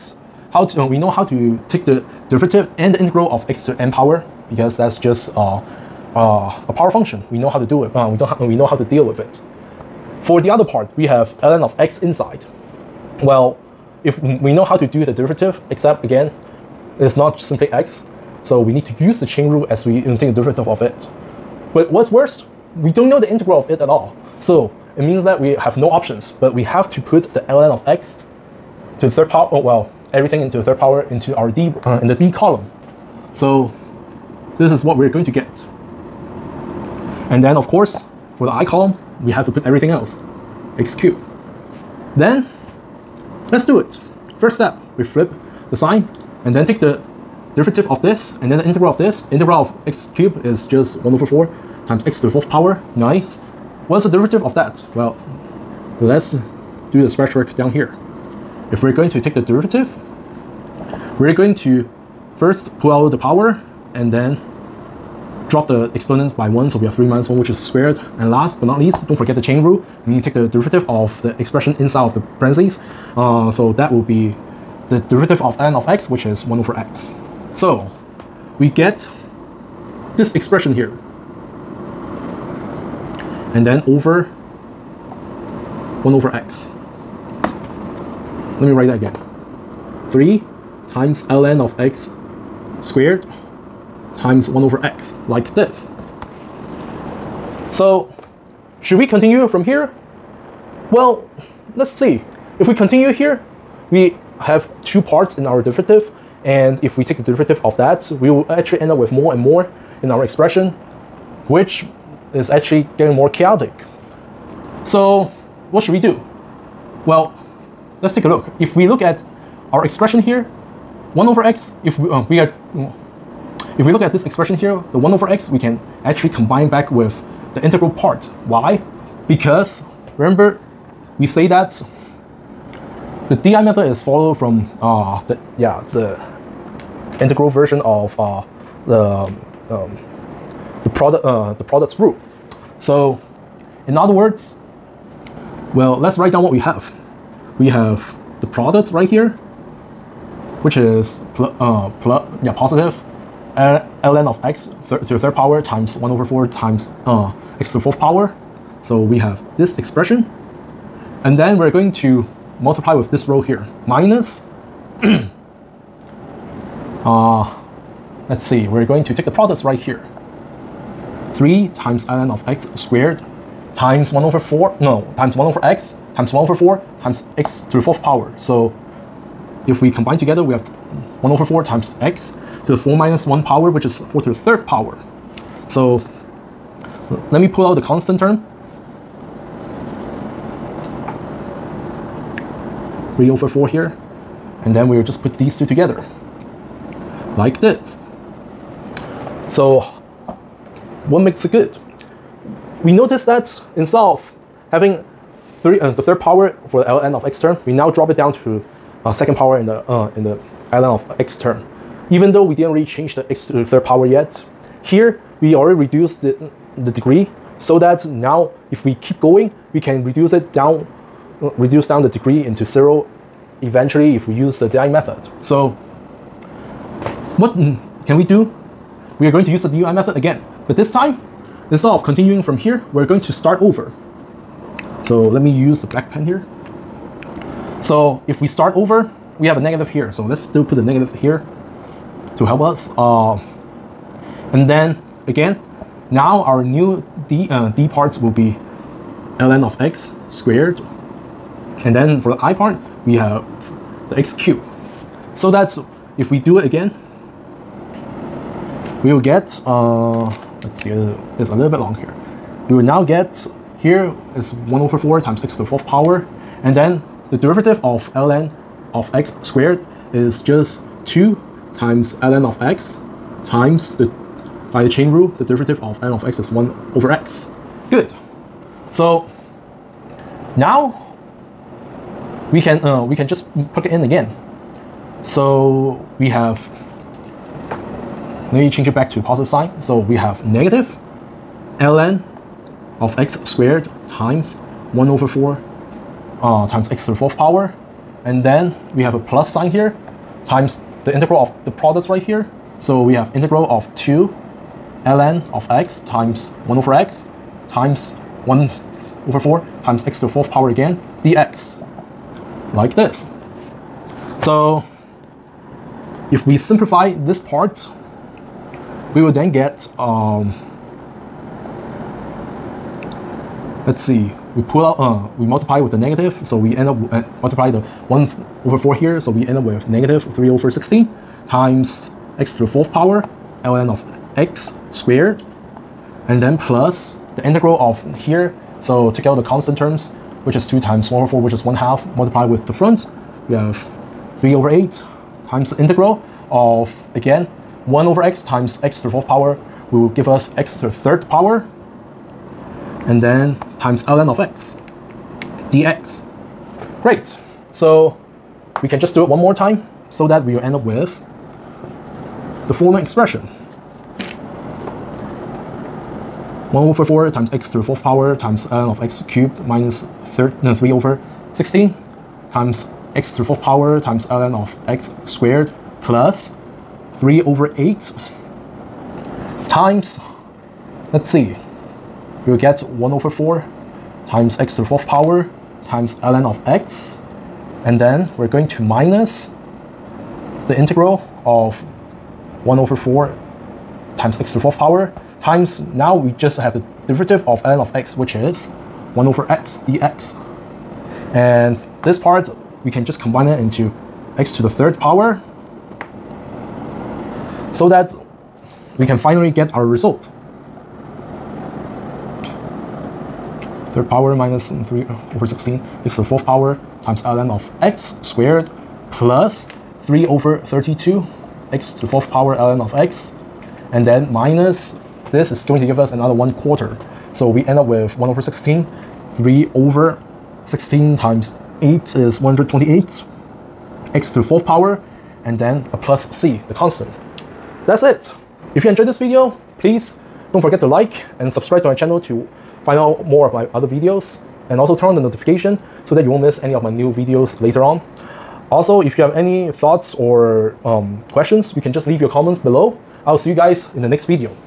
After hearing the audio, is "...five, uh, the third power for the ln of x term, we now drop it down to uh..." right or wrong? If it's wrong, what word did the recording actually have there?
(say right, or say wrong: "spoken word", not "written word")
wrong: "three", not "five".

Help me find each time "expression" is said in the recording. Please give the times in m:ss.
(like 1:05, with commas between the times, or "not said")
1:11, 1:20, 1:50, 1:59, 2:04, 2:39, 6:02.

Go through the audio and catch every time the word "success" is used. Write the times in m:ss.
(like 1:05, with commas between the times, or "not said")
not said.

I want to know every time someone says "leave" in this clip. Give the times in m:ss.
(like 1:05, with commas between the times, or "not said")
7:32.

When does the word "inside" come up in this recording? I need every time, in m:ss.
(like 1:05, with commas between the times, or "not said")
0:12, 1:11.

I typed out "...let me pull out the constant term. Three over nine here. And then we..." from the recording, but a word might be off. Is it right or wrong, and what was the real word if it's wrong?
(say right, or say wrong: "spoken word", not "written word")
wrong: "four", not "nine".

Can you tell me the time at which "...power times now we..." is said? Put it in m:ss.
6:34.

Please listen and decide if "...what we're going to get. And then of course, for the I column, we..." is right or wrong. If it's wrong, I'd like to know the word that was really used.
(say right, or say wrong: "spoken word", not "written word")
right.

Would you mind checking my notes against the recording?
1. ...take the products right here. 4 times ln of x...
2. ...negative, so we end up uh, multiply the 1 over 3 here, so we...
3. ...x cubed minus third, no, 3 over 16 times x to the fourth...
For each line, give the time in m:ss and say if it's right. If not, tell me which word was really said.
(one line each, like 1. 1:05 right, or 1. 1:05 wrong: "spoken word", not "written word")
1. 2:49 wrong: "3", not "4"
2. 5:25 wrong: "4", not "3"
3. 6:09 right.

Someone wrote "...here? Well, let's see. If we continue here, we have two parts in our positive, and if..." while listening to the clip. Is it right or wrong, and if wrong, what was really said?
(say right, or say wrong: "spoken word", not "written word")
wrong: "derivative", not "positive".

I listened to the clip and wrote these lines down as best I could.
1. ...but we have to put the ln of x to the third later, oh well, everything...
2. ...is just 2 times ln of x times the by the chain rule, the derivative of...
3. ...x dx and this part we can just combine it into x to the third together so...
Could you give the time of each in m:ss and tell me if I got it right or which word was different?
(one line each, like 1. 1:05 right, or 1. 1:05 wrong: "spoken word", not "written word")
1. 0:26 wrong: "power", not "later"
2. 4:30 right
3. 6:39 wrong: "power", not "together".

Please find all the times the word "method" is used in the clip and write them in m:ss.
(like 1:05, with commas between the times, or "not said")
2:13, 3:44, 3:49.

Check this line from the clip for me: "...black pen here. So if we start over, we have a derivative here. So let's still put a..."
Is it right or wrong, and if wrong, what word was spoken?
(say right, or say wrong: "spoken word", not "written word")
wrong: "negative", not "derivative".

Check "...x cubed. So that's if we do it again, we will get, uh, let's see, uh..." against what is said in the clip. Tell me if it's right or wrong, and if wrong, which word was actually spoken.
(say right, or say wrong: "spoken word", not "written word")
right.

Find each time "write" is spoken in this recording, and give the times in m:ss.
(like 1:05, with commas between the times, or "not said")
1:28, 2:26.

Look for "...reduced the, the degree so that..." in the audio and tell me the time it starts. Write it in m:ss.
3:35.